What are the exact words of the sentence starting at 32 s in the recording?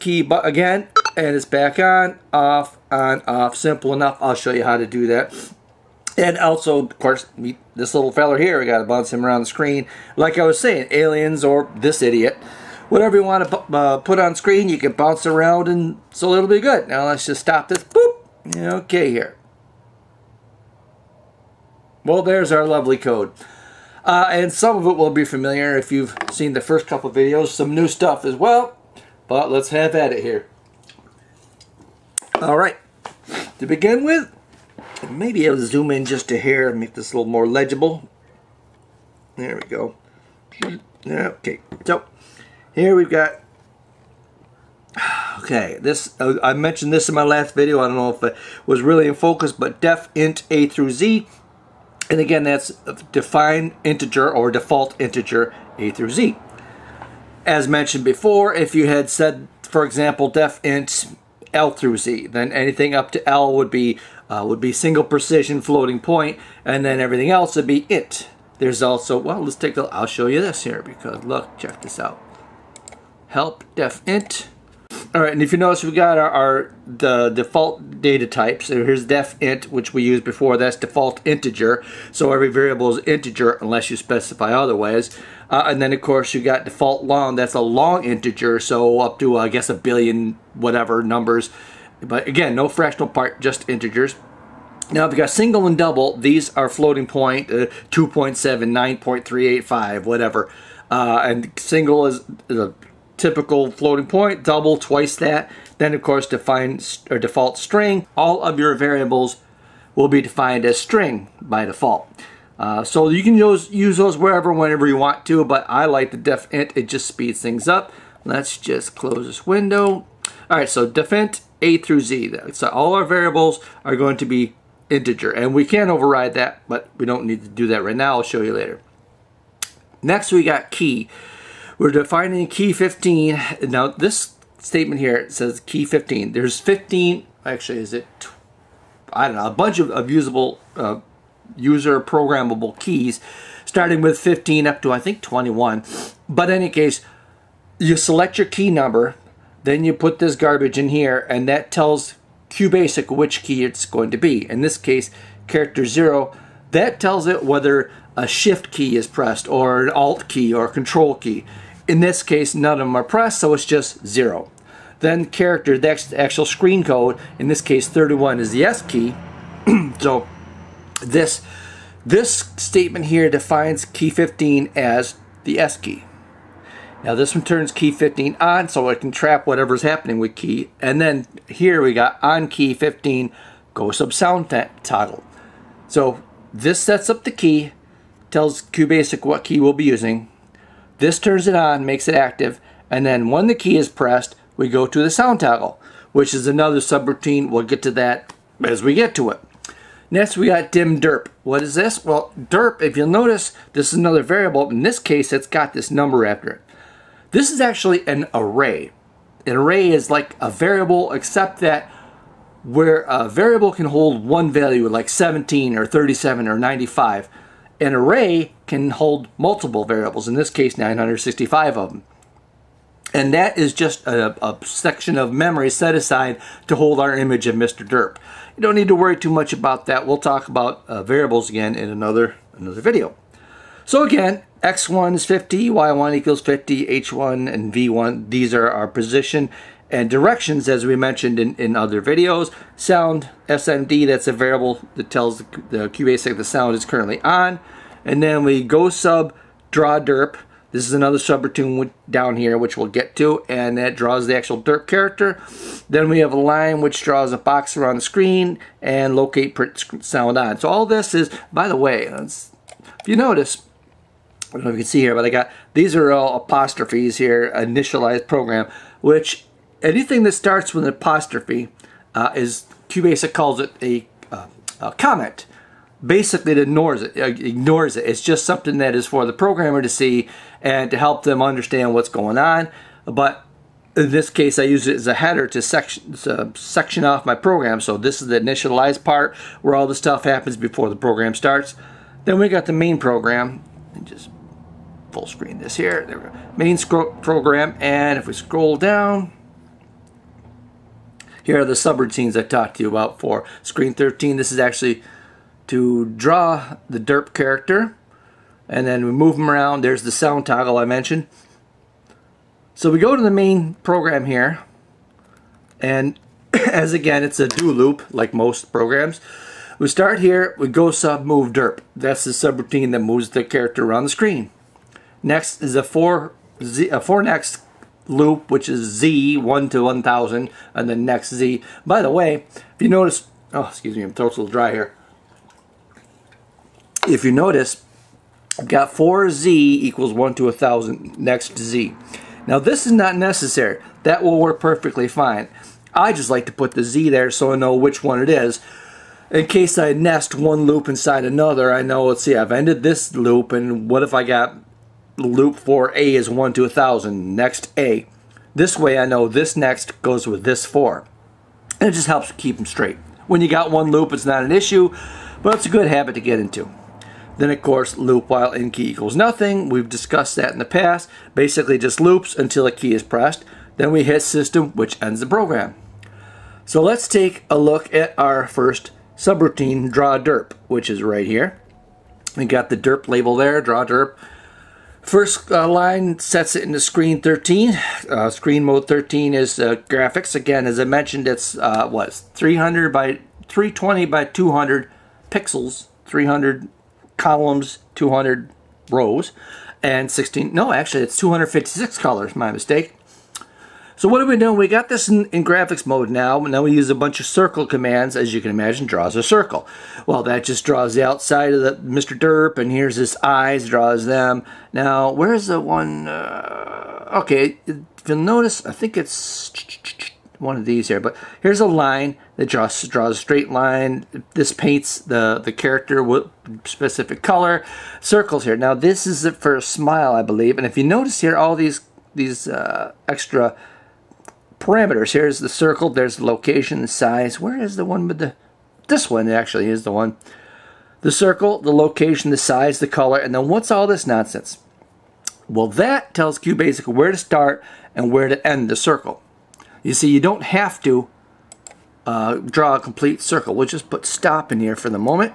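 All right, to begin with, maybe I'll zoom in just a hair and make this a little more legible.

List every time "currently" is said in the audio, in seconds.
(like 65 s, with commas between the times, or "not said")
246 s.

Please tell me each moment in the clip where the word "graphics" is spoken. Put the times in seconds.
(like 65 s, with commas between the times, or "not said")
389 s, 405 s.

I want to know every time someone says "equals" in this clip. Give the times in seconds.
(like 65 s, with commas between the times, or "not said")
236 s, 339 s, 368 s.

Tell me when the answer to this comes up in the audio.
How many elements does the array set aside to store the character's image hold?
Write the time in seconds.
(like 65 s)
220 s.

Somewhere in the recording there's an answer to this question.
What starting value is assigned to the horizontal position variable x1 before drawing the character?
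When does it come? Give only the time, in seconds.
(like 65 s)
234 s.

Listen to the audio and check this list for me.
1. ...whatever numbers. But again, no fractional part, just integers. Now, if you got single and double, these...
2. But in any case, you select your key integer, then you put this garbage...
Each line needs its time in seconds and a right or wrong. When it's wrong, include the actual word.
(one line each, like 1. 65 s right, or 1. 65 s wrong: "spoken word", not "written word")
1. 90 s right
2. 146 s wrong: "number", not "integer".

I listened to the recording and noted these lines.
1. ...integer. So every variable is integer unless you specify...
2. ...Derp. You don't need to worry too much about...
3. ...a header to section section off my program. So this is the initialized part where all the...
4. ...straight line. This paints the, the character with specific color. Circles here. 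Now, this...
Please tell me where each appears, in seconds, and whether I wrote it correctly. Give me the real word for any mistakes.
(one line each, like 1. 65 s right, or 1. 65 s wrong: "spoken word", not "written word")
1. 81 s right
2. 227 s right
3. 285 s right
4. 423 s right.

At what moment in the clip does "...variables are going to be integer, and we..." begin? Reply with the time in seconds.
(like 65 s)
123 s.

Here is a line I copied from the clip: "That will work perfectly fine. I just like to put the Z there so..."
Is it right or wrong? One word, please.
right.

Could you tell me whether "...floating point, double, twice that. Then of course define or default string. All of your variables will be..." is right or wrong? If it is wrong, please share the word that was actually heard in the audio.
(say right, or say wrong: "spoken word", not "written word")
right.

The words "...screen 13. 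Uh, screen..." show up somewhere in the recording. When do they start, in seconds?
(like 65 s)
386 s.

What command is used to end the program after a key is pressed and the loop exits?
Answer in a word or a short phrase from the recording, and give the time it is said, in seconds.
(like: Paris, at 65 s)
system, at 374 s.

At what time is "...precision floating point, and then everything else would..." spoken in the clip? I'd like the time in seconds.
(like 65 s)
65 s.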